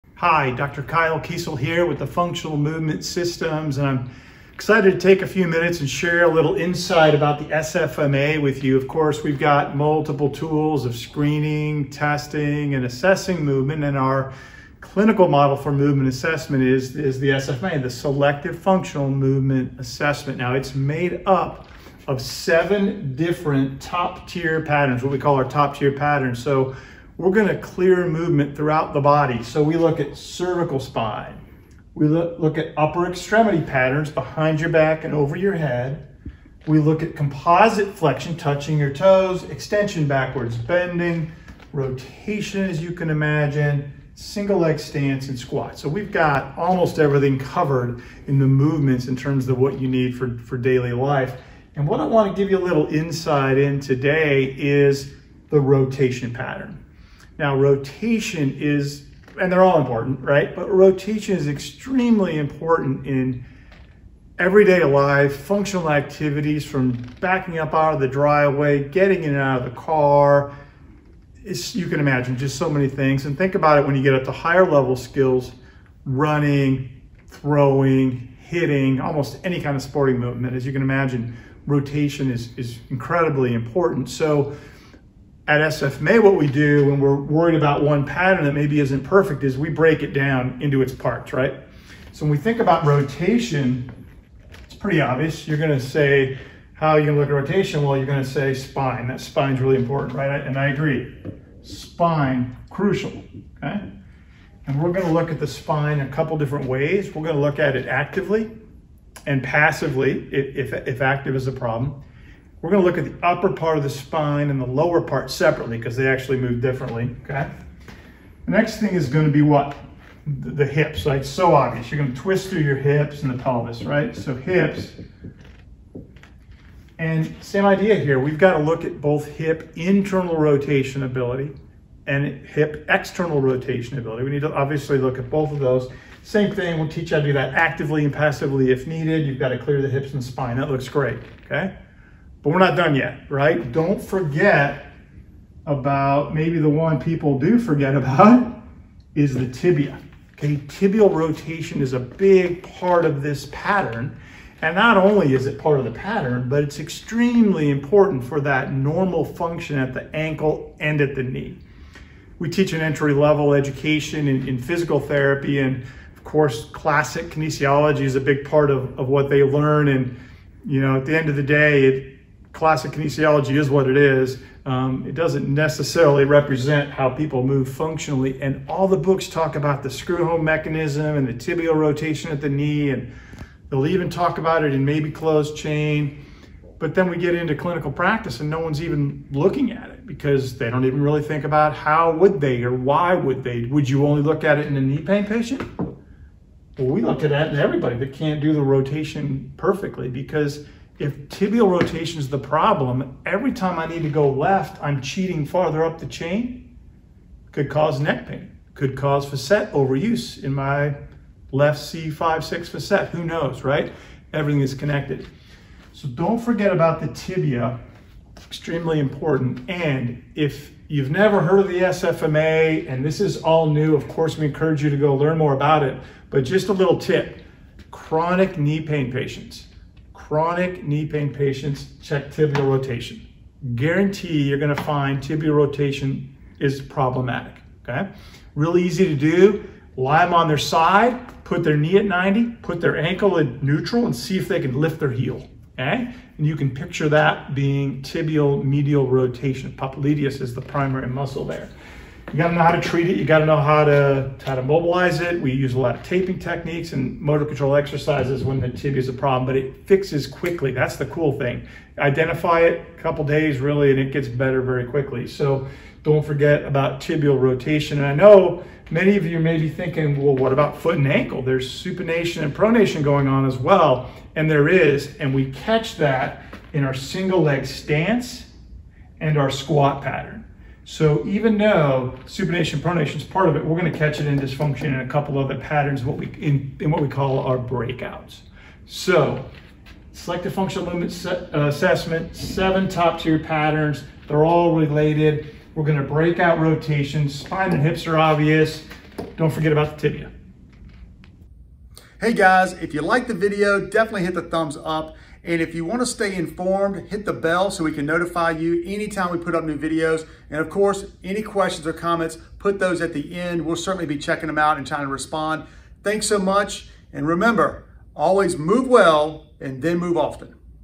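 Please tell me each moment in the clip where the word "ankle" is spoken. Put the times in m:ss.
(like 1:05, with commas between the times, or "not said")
2:40, 4:02, 4:31.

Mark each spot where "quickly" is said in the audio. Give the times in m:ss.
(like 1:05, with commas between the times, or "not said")
4:20, 4:24.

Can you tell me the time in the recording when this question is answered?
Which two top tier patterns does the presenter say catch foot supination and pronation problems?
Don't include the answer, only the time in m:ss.
4:36.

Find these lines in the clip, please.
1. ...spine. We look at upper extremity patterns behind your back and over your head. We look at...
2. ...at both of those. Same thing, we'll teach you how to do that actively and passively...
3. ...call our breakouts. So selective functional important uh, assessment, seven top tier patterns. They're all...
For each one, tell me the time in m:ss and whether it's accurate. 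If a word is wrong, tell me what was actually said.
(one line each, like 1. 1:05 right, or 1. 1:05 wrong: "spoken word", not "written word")
1. 0:30 right
2. 2:15 right
3. 4:47 wrong: "movement", not "important".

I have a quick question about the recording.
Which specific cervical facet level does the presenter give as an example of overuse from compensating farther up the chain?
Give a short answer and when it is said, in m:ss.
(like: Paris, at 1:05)
C5-6, at 3:31.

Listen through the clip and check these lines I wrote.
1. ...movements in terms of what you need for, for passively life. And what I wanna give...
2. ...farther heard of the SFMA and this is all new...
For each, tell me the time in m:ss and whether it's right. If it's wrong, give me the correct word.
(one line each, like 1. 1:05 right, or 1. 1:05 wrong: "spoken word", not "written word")
1. 0:48 wrong: "daily", not "passively"
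2. 3:41 wrong: "never", not "farther".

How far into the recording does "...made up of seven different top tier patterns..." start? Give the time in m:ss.
0:20.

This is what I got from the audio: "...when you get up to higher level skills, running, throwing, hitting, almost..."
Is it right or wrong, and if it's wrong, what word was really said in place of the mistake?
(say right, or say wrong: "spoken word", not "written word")
right.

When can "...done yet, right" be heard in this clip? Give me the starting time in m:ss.
2:22.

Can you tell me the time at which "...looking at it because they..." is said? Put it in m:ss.
3:09.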